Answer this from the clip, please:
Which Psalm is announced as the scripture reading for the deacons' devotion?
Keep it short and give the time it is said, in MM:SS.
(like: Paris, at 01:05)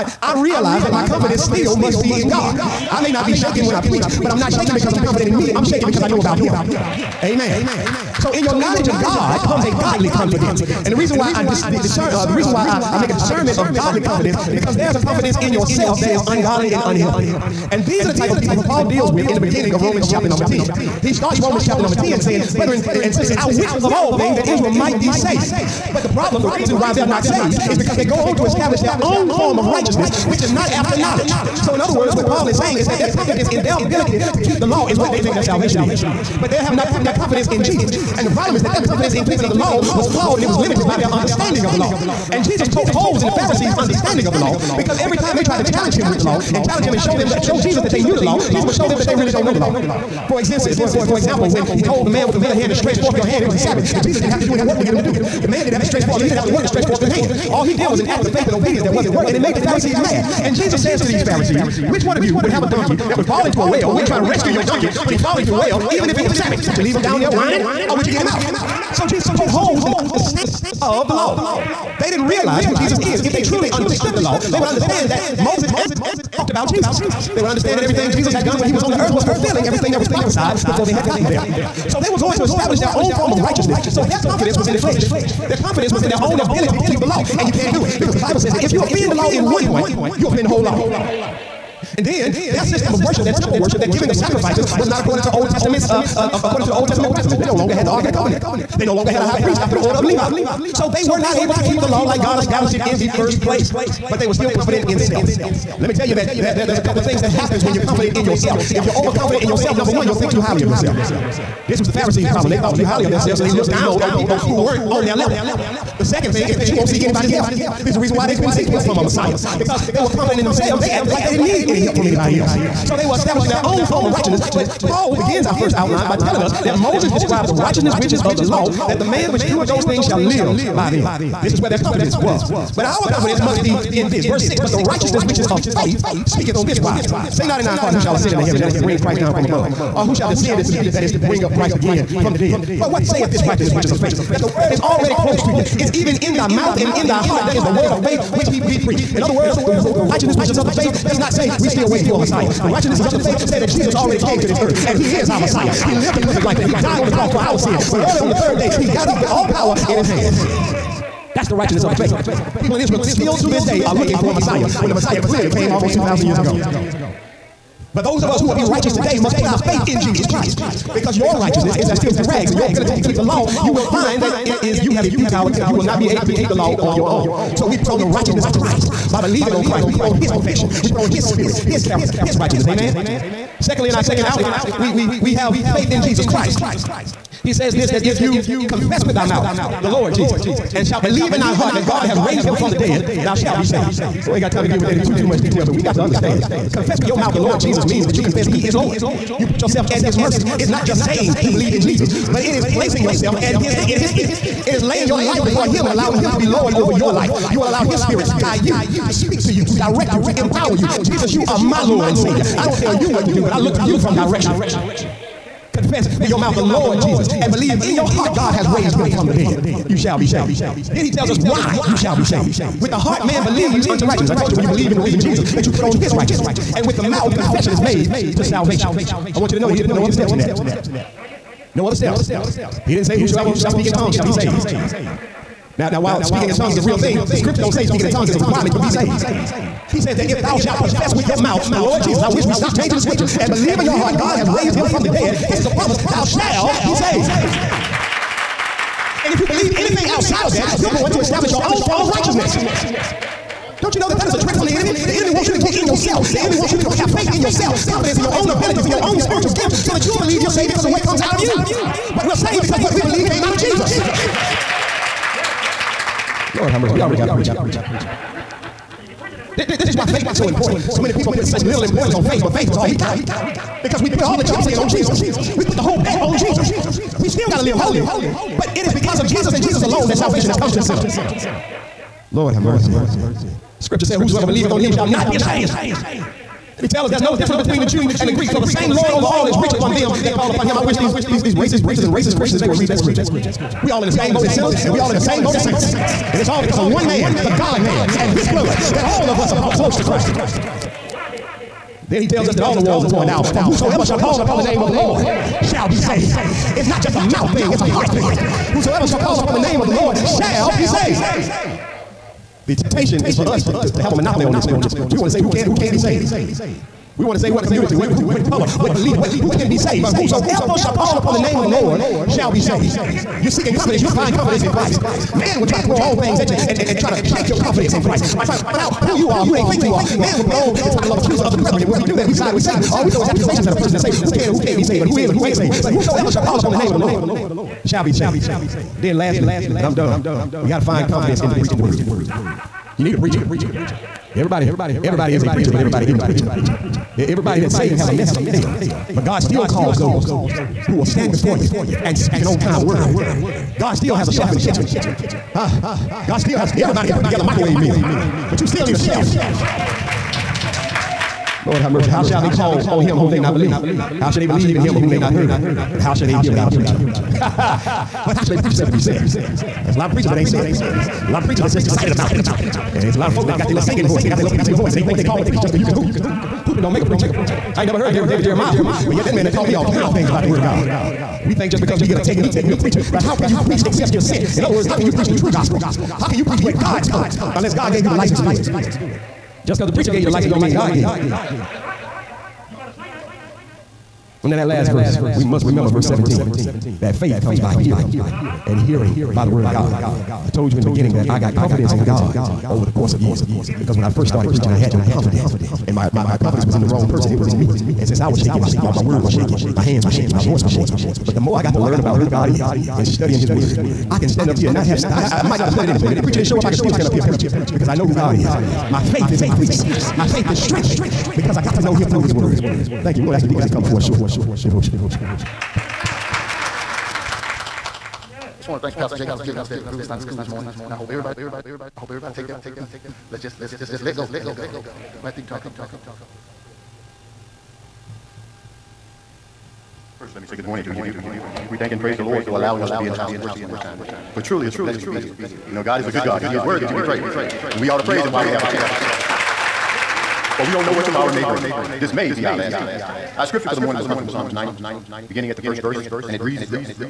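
Psalm 90, at 07:34.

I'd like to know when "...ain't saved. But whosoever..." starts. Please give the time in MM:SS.
05:35.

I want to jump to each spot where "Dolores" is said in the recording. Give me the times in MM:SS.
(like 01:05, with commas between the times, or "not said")
not said.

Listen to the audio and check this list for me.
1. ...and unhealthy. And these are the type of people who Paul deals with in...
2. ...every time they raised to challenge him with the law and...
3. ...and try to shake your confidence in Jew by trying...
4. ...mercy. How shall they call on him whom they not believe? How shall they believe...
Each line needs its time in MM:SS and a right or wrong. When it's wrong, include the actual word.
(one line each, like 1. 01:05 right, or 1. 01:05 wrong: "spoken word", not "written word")
1. 00:16 right
2. 00:44 wrong: "tried", not "raised"
3. 05:26 wrong: "Christ", not "Jew"
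4. 06:01 right.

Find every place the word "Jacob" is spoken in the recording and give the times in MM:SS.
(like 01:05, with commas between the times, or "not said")
07:09.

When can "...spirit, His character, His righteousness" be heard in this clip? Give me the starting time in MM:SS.
03:01.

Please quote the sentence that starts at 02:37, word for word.
But early on the third day, he got up with all power in his hands.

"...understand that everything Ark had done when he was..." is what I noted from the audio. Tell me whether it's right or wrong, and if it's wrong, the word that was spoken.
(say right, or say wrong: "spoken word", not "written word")
wrong: "Jesus", not "Ark".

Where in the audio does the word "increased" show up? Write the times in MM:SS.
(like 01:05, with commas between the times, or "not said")
06:59.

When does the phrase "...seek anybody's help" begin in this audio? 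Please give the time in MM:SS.
01:56.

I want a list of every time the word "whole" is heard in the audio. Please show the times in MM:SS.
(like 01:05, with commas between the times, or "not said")
01:30, 04:35.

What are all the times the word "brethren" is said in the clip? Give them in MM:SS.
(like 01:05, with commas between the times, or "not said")
00:22, 05:31.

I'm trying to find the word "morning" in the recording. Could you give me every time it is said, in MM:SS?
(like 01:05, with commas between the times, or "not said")
07:10, 07:20, 07:33.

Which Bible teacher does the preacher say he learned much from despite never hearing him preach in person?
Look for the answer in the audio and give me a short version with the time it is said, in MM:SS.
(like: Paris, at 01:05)
David Jeremiah, at 06:18.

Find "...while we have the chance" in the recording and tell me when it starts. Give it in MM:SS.
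07:28.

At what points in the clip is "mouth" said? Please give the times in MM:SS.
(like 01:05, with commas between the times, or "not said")
02:26, 03:09, 03:17, 03:36, 03:47, 04:01, 05:07.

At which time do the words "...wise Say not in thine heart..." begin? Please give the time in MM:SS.
02:16.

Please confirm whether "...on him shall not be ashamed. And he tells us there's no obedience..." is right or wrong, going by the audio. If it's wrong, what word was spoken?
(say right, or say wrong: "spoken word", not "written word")
wrong: "difference", not "obedience".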